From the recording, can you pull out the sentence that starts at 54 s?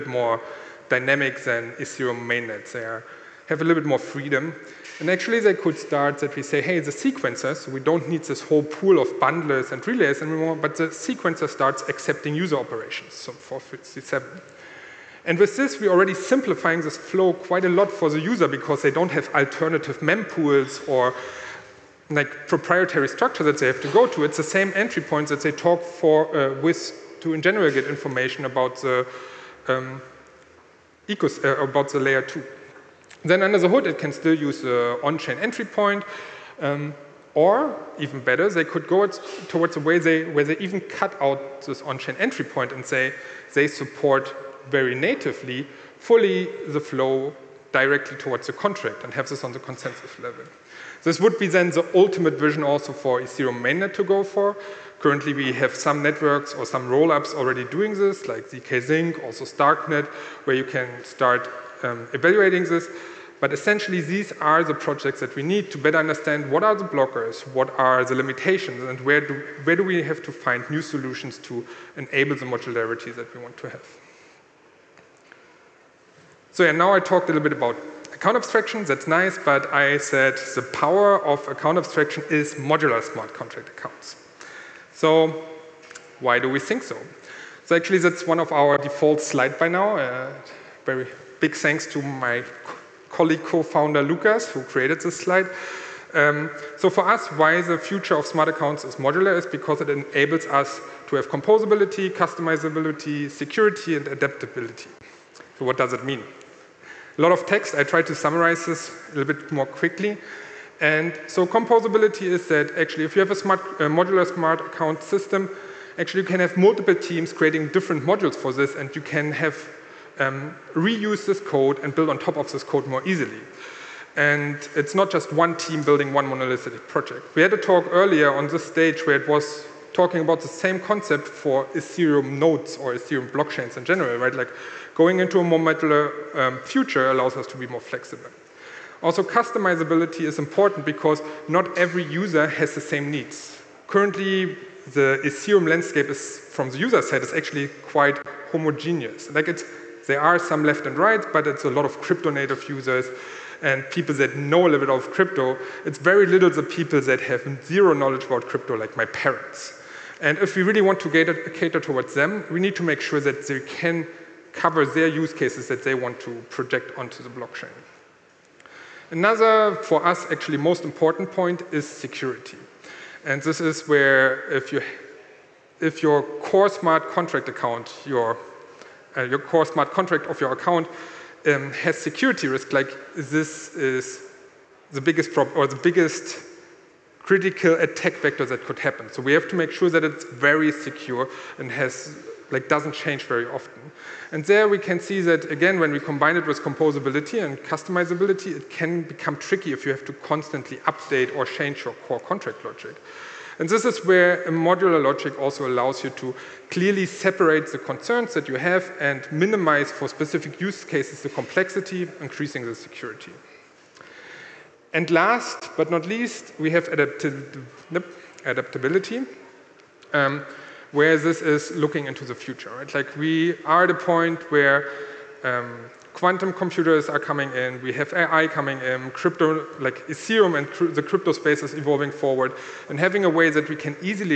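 Currently, we have some networks or some rollups already doing this, like zkSync, also Starknet, where you can start um, evaluating this.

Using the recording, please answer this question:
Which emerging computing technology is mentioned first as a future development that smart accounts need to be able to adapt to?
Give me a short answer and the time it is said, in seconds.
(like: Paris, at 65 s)
quantum computers, at 226 s.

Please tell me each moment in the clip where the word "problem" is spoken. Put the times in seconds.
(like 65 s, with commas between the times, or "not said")
185 s.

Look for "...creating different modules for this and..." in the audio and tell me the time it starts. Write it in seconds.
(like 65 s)
117 s.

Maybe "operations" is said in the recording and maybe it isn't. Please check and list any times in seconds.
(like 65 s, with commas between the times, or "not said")
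12 s.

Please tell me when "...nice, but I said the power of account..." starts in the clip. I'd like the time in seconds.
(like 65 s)
79 s.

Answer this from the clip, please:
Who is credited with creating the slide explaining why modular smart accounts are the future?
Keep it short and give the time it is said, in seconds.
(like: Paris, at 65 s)
Lucas, at 94 s.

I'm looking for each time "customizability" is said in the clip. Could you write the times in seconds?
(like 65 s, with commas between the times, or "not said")
102 s, 139 s, 197 s.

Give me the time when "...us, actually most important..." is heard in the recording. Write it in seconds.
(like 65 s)
170 s.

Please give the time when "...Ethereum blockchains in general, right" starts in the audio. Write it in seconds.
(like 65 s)
132 s.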